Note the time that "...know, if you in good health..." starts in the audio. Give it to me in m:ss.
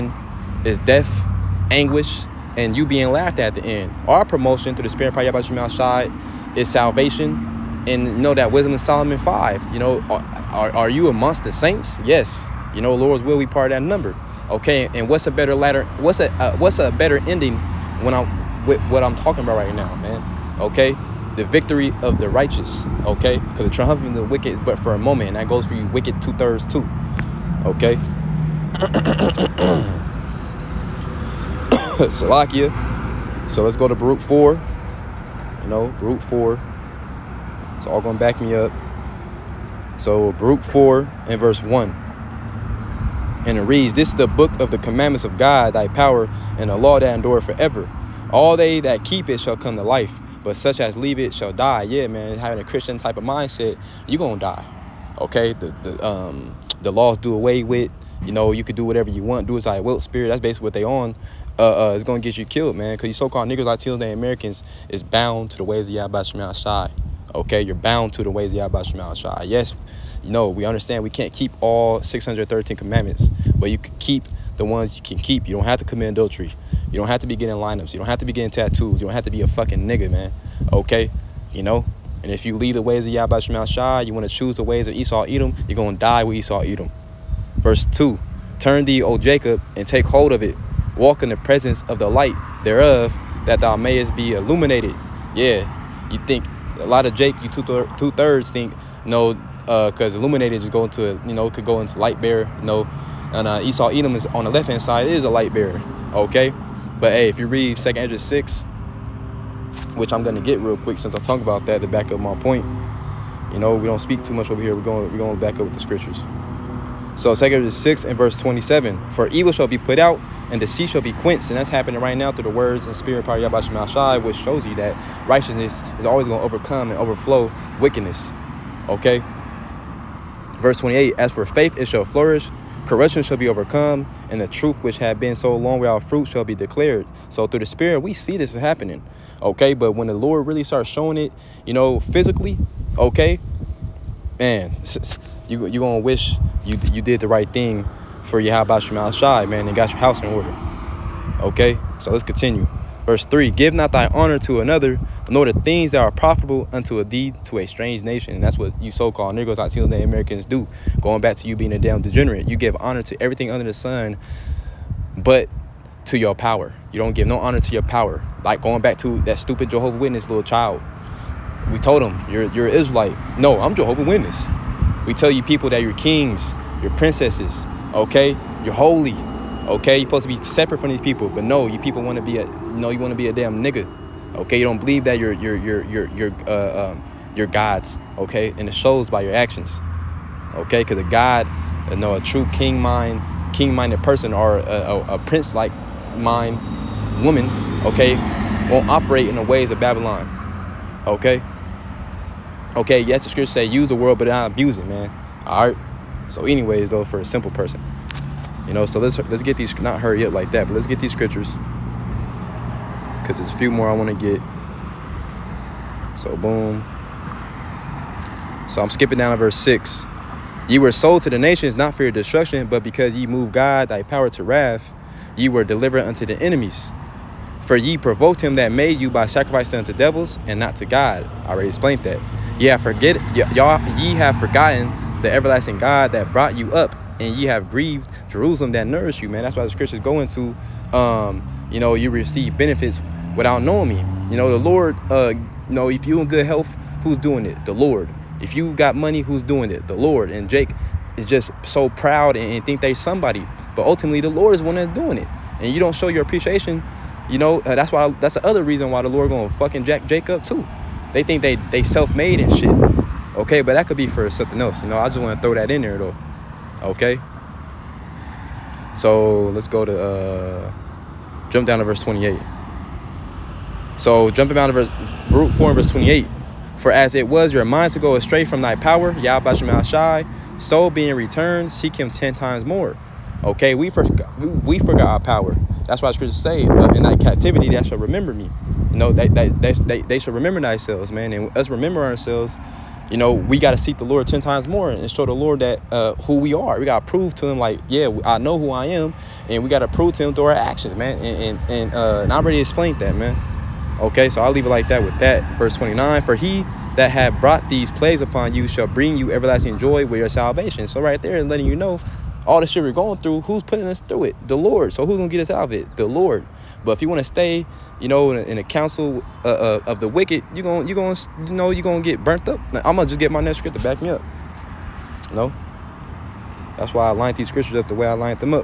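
4:05.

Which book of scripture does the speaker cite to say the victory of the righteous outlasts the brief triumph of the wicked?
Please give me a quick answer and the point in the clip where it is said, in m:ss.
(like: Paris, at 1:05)
Wisdom of Solomon 5, at 0:08.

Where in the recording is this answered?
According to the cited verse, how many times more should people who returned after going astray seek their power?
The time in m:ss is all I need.
4:42.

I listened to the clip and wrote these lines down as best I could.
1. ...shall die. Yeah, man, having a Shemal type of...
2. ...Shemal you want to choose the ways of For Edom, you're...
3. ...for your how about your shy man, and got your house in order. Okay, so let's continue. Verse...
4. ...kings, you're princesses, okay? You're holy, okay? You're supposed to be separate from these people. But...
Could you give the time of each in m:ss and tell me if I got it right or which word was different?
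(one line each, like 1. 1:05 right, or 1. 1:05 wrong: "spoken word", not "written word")
1. 0:51 wrong: "Christian", not "Shemal"
2. 1:23 wrong: "Esau", not "For"
3. 2:28 right
4. 2:55 right.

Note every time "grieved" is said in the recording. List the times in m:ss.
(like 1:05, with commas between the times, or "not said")
3:57.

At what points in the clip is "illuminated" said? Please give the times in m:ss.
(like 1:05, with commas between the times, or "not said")
1:34, 1:40.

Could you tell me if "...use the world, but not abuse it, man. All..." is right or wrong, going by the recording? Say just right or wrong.
right.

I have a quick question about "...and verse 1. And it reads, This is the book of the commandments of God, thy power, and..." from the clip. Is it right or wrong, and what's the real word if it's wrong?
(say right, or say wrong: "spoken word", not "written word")
right.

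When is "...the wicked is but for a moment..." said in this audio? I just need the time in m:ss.
0:24.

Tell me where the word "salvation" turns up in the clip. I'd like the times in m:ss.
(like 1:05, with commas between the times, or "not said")
0:06, 5:10.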